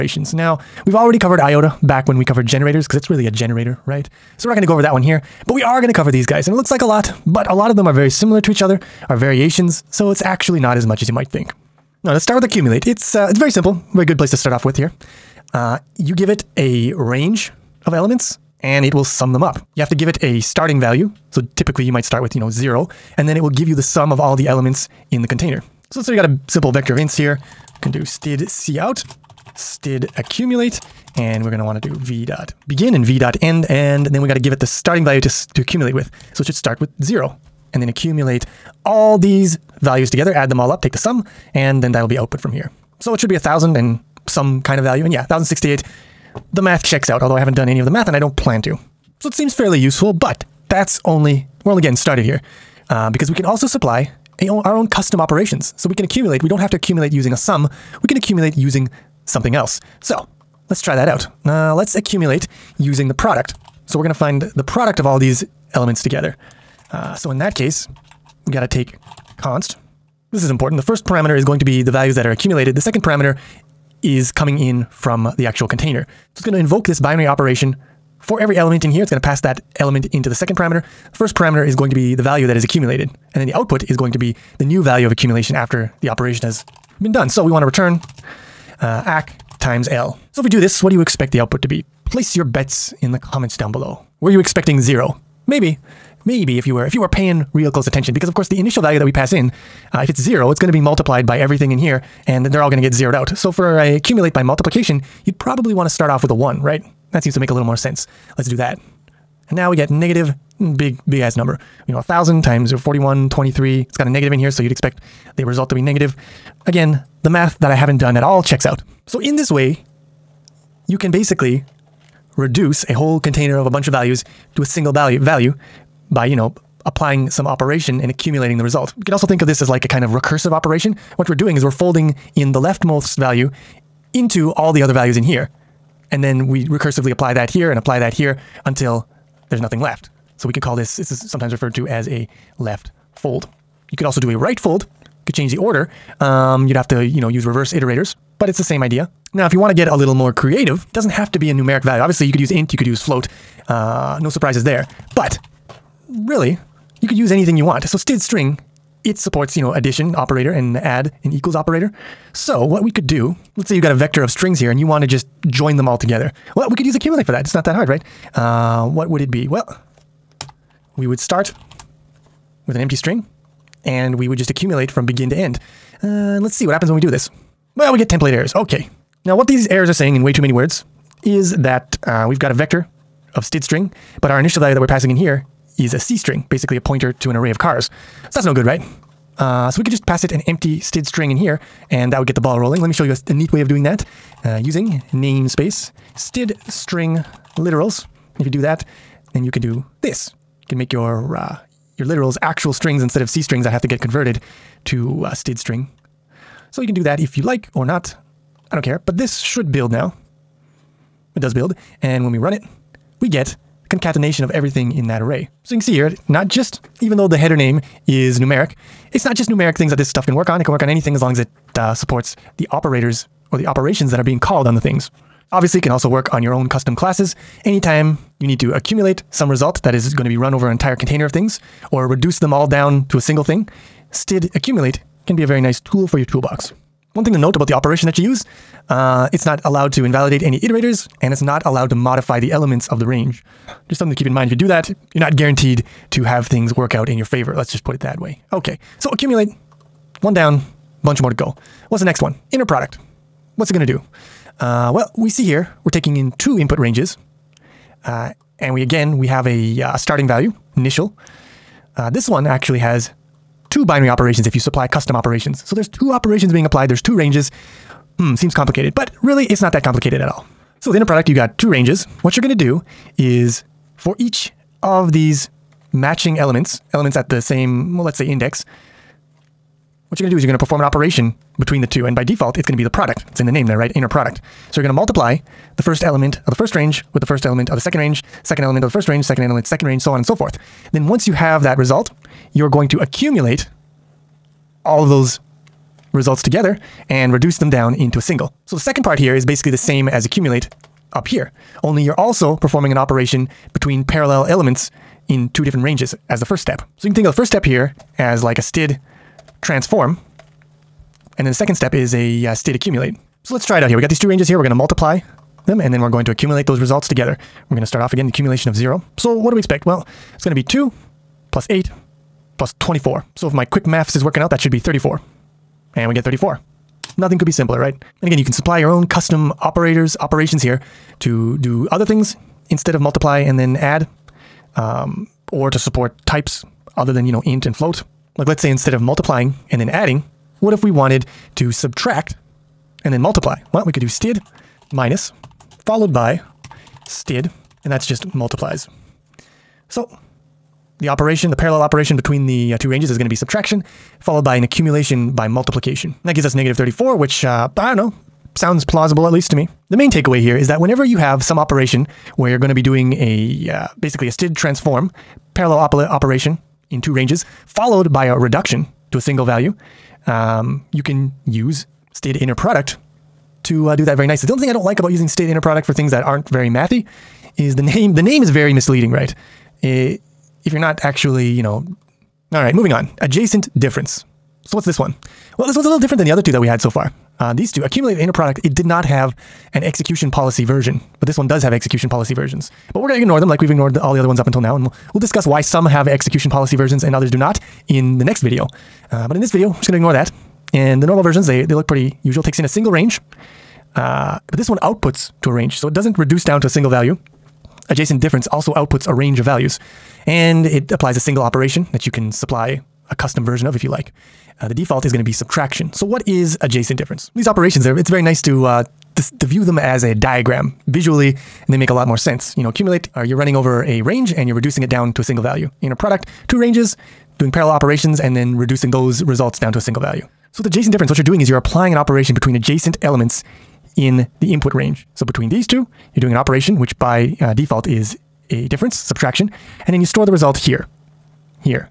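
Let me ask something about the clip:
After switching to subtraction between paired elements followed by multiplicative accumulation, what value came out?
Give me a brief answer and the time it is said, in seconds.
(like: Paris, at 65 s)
-34, at 356 s.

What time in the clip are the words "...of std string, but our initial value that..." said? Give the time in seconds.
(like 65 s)
183 s.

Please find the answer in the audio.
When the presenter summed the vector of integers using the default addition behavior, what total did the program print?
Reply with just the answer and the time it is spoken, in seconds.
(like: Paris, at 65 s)
1068, at 45 s.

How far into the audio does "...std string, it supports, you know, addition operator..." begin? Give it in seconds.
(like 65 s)
157 s.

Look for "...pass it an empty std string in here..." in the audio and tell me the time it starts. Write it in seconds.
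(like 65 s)
190 s.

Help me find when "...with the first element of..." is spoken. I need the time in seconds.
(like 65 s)
287 s.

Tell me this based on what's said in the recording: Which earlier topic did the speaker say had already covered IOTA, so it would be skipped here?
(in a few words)
generators.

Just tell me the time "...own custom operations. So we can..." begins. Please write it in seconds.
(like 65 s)
54 s.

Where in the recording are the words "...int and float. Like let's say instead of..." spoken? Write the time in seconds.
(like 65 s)
337 s.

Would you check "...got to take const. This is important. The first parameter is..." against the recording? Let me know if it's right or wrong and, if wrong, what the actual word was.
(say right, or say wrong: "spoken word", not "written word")
right.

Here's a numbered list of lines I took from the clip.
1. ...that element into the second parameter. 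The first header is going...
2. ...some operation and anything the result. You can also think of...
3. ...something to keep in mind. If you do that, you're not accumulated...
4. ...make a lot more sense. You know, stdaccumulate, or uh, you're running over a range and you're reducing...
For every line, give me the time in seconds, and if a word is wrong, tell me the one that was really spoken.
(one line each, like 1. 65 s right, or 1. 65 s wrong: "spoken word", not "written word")
1. 79 s wrong: "parameter", not "header"
2. 127 s wrong: "accumulating", not "anything"
3. 243 s wrong: "guaranteed", not "accumulated"
4. 421 s wrong: "accumulate", not "stdaccumulate".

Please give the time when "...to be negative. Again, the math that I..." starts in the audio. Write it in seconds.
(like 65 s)
115 s.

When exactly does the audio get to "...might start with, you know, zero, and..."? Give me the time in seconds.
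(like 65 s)
21 s.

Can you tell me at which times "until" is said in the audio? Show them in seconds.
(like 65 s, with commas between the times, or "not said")
138 s, 394 s.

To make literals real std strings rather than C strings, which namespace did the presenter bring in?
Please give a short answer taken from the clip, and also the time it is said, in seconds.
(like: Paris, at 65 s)
std string literals, at 195 s.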